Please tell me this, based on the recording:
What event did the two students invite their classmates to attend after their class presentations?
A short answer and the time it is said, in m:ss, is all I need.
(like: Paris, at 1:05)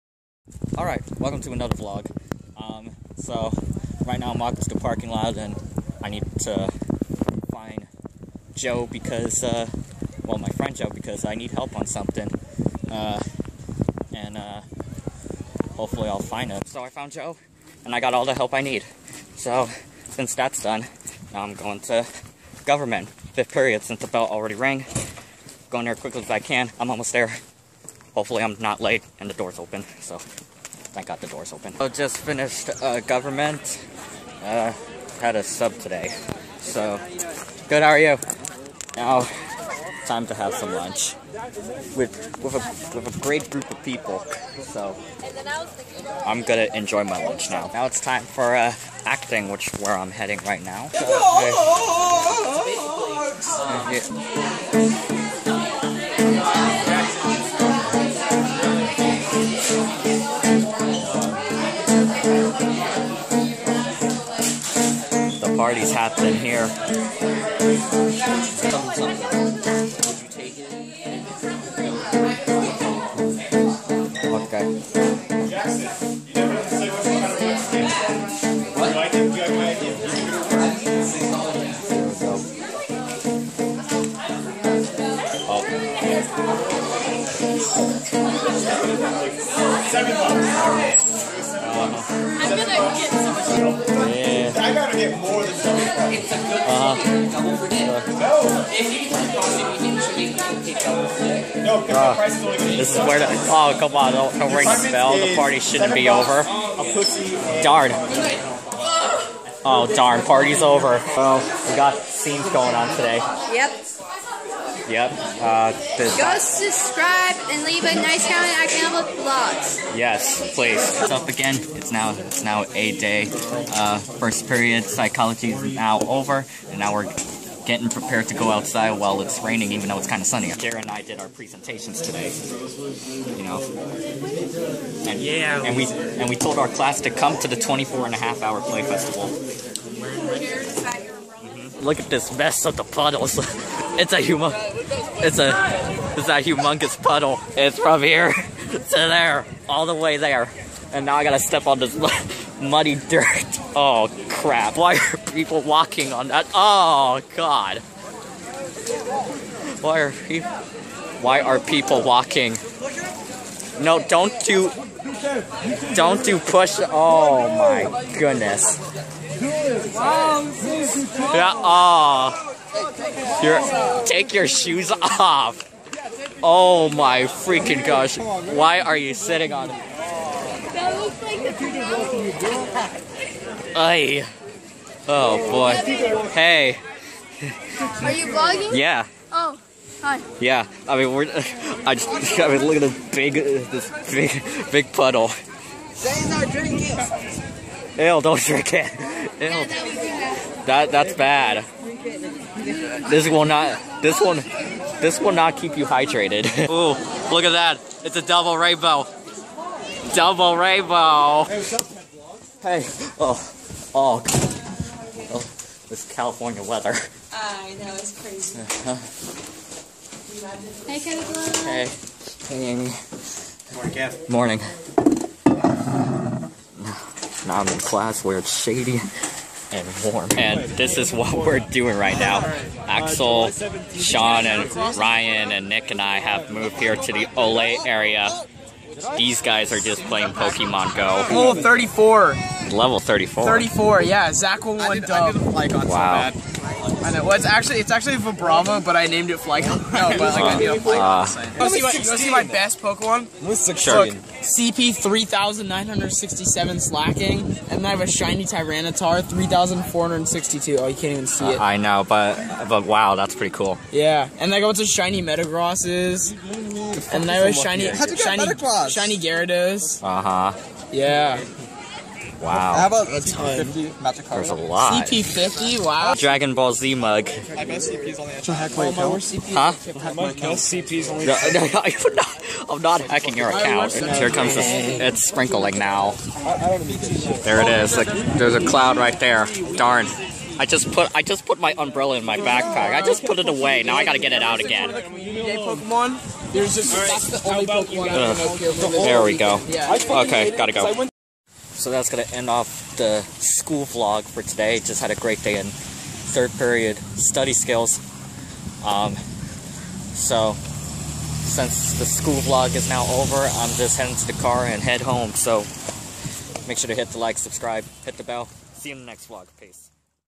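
24 and a half hour play festival, at 2:17.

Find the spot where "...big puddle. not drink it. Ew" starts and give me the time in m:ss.
3:14.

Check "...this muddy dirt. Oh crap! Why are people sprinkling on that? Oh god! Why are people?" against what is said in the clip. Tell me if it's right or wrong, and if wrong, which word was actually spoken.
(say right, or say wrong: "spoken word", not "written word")
wrong: "walking", not "sprinkling".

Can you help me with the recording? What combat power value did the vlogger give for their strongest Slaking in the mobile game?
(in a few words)
3967.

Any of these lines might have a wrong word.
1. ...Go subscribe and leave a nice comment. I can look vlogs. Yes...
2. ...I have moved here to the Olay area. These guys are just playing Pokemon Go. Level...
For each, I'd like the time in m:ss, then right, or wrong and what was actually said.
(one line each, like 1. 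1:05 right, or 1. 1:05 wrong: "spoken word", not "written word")
1. 1:55 right
2. 3:56 right.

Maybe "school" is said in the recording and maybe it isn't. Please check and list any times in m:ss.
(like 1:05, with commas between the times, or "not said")
5:03, 5:12.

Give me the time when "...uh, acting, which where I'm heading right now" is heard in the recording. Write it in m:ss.
0:48.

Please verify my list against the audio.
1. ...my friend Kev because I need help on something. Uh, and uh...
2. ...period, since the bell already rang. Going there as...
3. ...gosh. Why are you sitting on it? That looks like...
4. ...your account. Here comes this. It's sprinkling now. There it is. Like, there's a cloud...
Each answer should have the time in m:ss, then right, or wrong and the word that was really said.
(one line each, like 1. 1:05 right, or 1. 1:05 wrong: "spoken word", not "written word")
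1. 0:10 wrong: "Joe", not "Kev"
2. 0:23 right
3. 2:57 right
4. 4:43 right.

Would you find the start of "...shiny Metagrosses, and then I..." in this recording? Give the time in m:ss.
4:24.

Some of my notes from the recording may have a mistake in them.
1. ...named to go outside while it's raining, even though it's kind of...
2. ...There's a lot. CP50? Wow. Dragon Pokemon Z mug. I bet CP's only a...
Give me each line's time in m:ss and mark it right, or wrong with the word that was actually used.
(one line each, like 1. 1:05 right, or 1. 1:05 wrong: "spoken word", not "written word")
1. 2:07 wrong: "prepared", not "named"
2. 4:34 wrong: "Ball", not "Pokemon".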